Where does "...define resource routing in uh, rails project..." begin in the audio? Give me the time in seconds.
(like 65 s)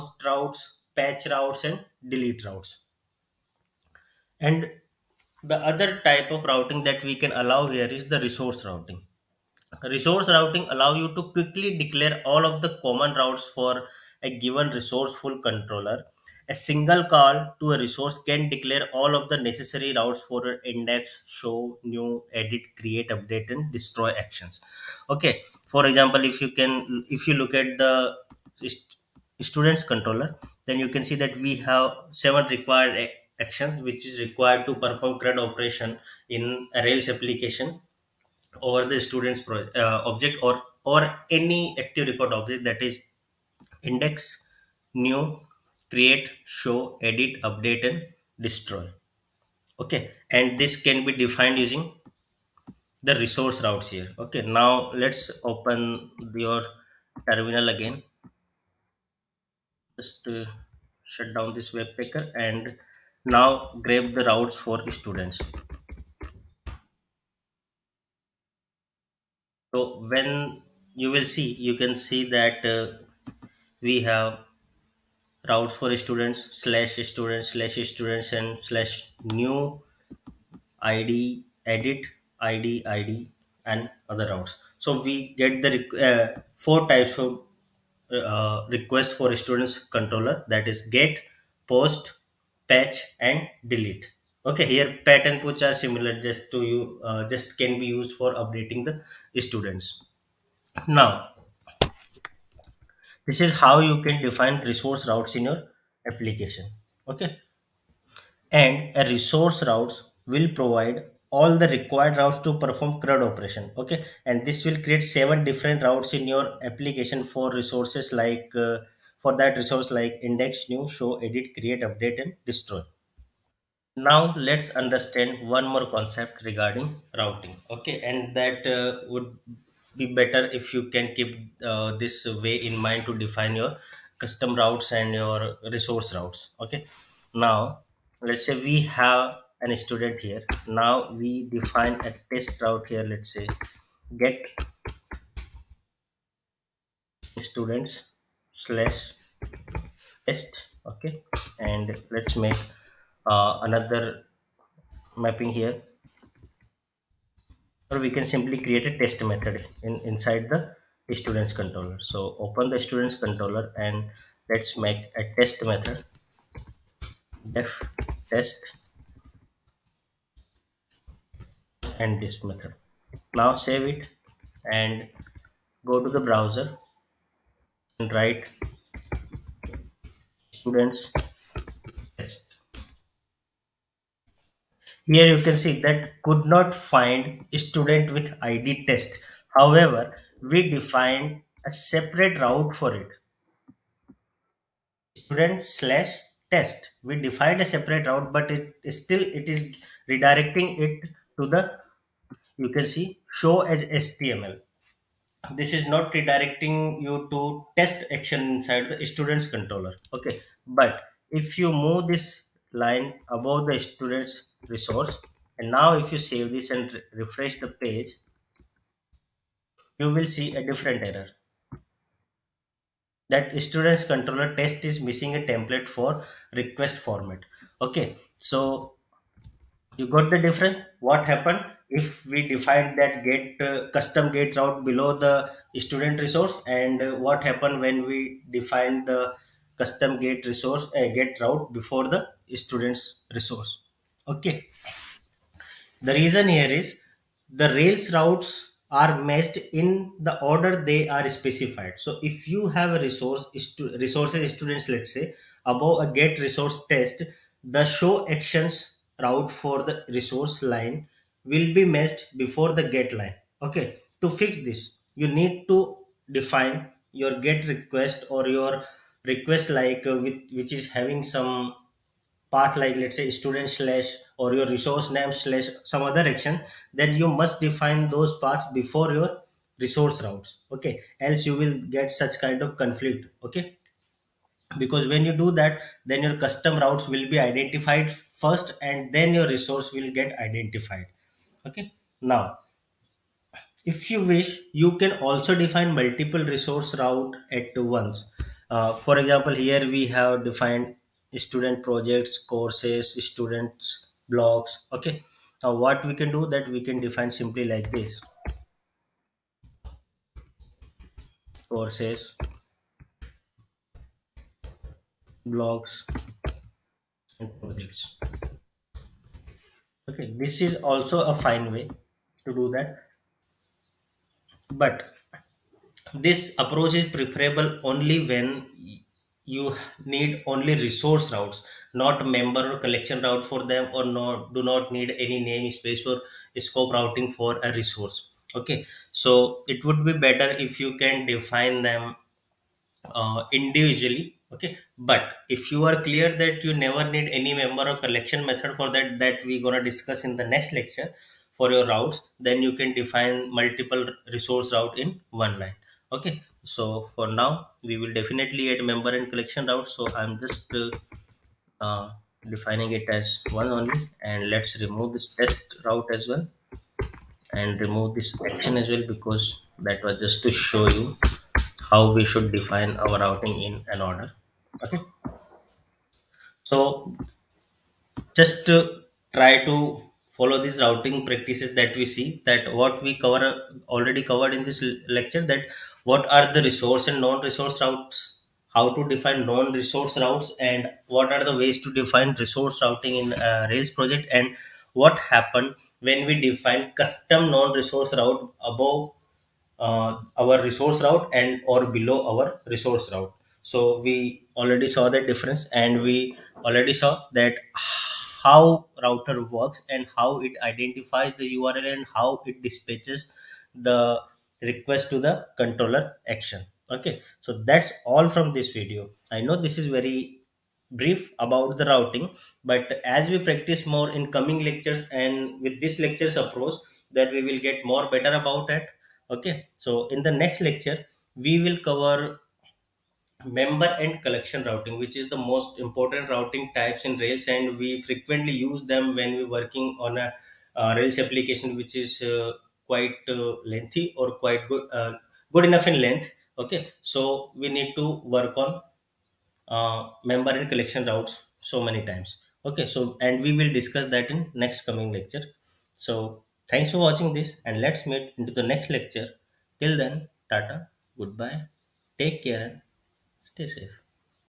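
391 s.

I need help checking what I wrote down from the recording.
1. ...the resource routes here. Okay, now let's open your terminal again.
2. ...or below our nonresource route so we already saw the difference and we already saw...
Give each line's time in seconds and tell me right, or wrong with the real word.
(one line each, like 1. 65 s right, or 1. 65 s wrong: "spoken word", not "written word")
1. 53 s right
2. 401 s wrong: "resource", not "nonresource".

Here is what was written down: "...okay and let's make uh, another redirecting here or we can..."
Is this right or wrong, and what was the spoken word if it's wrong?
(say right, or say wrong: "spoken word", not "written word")
wrong: "mapping", not "redirecting".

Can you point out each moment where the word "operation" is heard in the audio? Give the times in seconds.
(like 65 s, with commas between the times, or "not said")
35 s, 113 s.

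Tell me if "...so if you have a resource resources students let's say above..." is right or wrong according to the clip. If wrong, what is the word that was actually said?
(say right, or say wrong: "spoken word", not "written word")
right.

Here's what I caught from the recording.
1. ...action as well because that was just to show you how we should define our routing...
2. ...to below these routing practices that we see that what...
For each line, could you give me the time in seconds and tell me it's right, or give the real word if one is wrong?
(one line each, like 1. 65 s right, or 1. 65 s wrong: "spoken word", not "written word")
1. 368 s right
2. 379 s wrong: "follow", not "below".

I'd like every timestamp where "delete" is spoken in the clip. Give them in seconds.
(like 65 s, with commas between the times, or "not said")
2 s, 93 s.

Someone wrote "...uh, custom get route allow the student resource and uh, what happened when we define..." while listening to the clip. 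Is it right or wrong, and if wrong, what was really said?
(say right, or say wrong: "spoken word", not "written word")
wrong: "below", not "allow".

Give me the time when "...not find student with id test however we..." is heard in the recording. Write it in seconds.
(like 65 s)
186 s.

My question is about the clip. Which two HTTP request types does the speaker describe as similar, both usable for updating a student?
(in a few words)
patch and put.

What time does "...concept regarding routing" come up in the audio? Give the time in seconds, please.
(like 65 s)
125 s.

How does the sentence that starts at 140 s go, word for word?
Now we define a test route here.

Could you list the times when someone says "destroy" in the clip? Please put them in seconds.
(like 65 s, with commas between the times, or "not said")
23 s, 48 s, 122 s.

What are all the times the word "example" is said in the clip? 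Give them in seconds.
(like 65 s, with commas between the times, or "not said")
25 s, 299 s.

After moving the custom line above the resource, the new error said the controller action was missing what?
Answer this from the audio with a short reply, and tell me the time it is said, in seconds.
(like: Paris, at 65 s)
a template, at 225 s.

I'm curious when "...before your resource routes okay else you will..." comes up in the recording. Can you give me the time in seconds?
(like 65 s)
278 s.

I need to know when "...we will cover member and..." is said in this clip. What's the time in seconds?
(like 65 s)
431 s.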